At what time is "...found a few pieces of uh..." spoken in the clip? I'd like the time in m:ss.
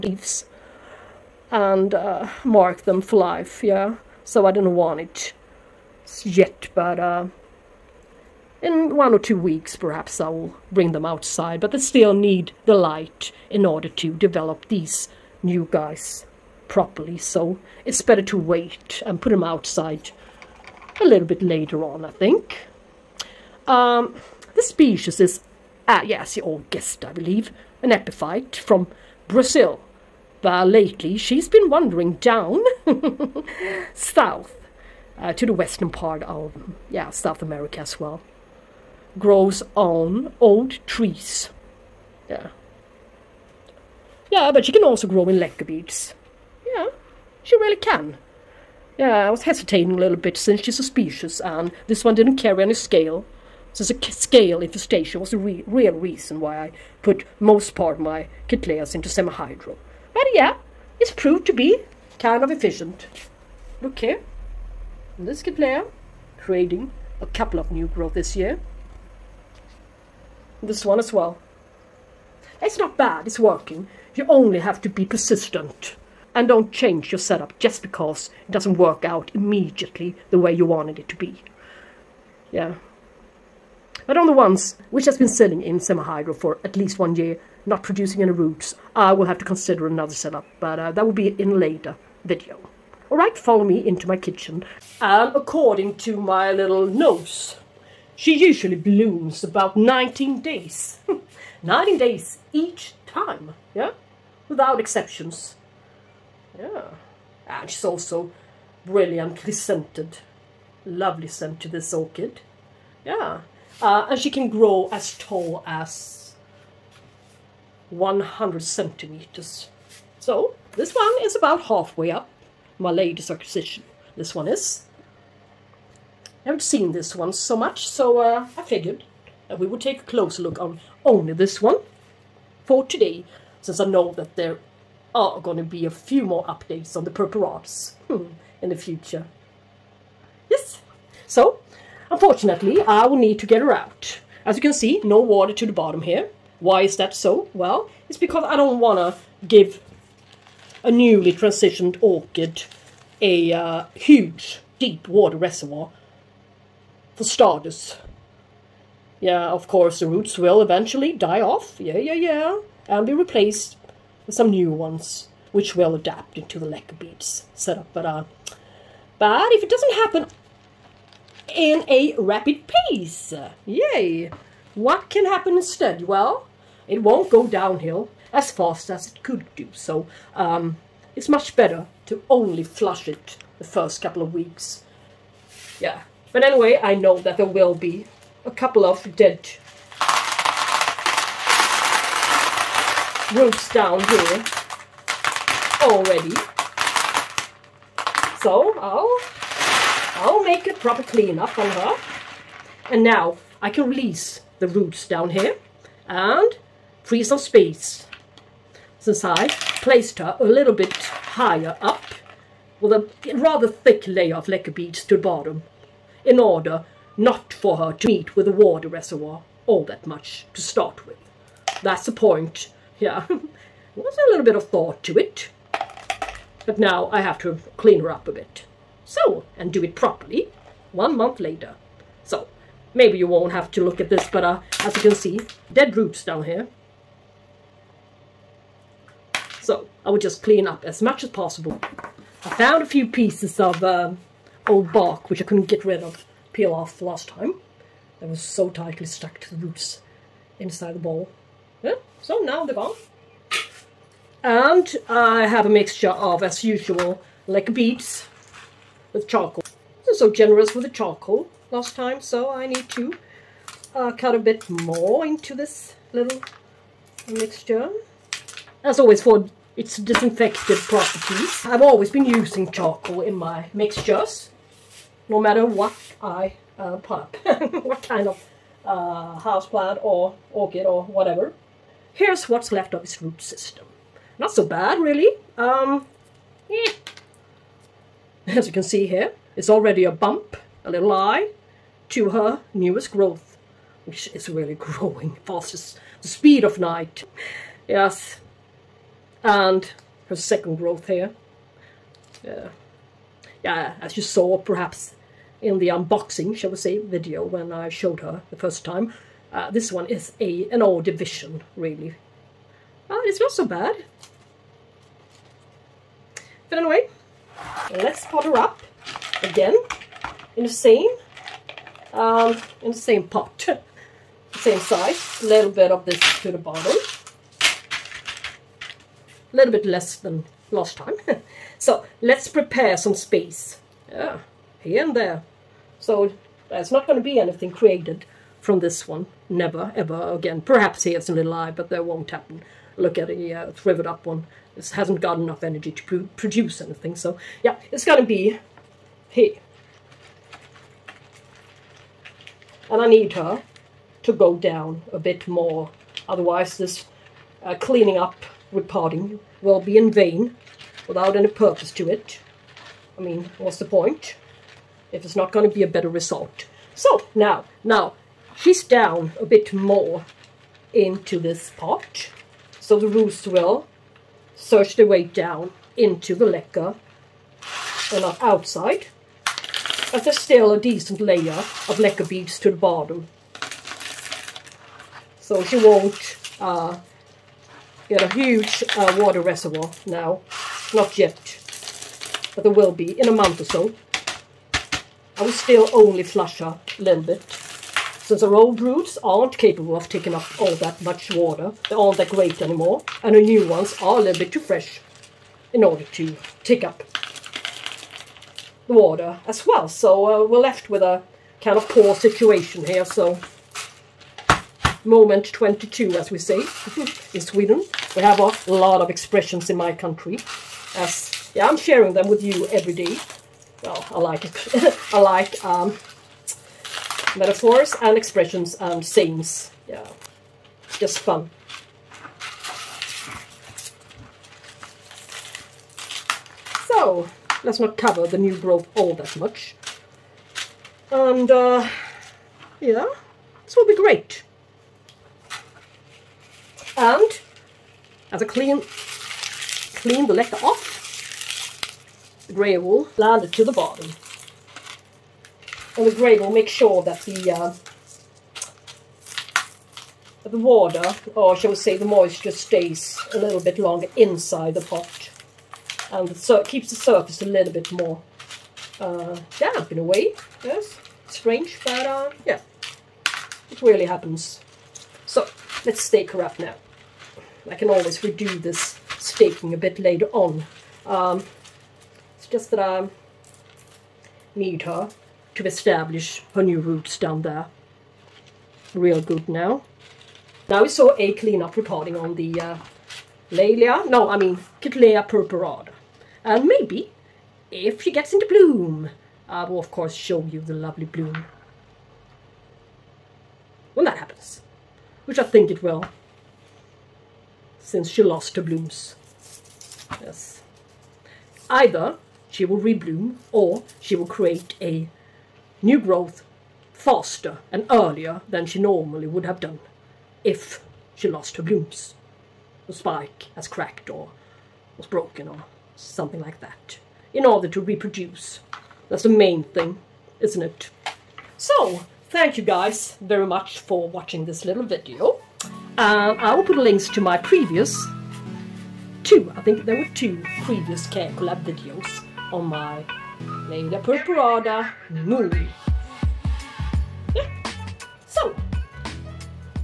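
4:02.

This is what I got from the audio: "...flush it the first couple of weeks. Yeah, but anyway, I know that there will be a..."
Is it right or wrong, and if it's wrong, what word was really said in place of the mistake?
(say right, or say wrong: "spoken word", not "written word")
right.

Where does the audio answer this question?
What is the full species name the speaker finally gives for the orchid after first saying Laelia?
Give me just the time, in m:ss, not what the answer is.
8:14.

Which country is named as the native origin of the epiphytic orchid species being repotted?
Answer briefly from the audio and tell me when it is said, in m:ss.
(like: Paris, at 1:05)
Brazil, at 0:29.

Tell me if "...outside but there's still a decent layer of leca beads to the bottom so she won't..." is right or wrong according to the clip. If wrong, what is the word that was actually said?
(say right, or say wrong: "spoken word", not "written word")
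right.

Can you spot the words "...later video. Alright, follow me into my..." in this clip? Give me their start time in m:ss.
1:31.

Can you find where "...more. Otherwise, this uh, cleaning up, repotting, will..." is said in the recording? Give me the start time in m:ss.
5:55.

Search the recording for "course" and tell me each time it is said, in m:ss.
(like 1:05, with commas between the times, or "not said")
2:39, 8:19.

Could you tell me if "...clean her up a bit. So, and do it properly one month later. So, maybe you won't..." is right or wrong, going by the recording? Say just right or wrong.
right.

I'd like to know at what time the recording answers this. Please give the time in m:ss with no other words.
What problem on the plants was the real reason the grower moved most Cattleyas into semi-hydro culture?
0:54.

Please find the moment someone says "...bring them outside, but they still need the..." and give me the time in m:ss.
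0:10.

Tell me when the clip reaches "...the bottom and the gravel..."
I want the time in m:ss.
7:33.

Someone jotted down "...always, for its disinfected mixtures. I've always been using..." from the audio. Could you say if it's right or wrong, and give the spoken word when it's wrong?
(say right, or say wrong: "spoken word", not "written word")
wrong: "properties", not "mixtures".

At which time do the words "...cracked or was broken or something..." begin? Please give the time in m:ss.
8:43.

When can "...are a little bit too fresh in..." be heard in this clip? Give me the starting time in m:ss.
6:44.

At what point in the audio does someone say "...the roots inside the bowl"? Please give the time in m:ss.
4:09.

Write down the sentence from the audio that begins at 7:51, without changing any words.
Strange, but uh, yeah, it really happens.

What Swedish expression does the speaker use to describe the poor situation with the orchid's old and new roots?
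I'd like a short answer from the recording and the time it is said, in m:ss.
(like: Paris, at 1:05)
moment 22, at 6:55.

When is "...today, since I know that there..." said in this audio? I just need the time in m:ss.
2:12.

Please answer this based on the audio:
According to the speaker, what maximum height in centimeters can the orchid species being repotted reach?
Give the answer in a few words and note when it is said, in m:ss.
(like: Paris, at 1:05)
100, at 1:57.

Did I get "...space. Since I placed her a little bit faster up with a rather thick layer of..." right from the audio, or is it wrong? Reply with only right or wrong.
wrong.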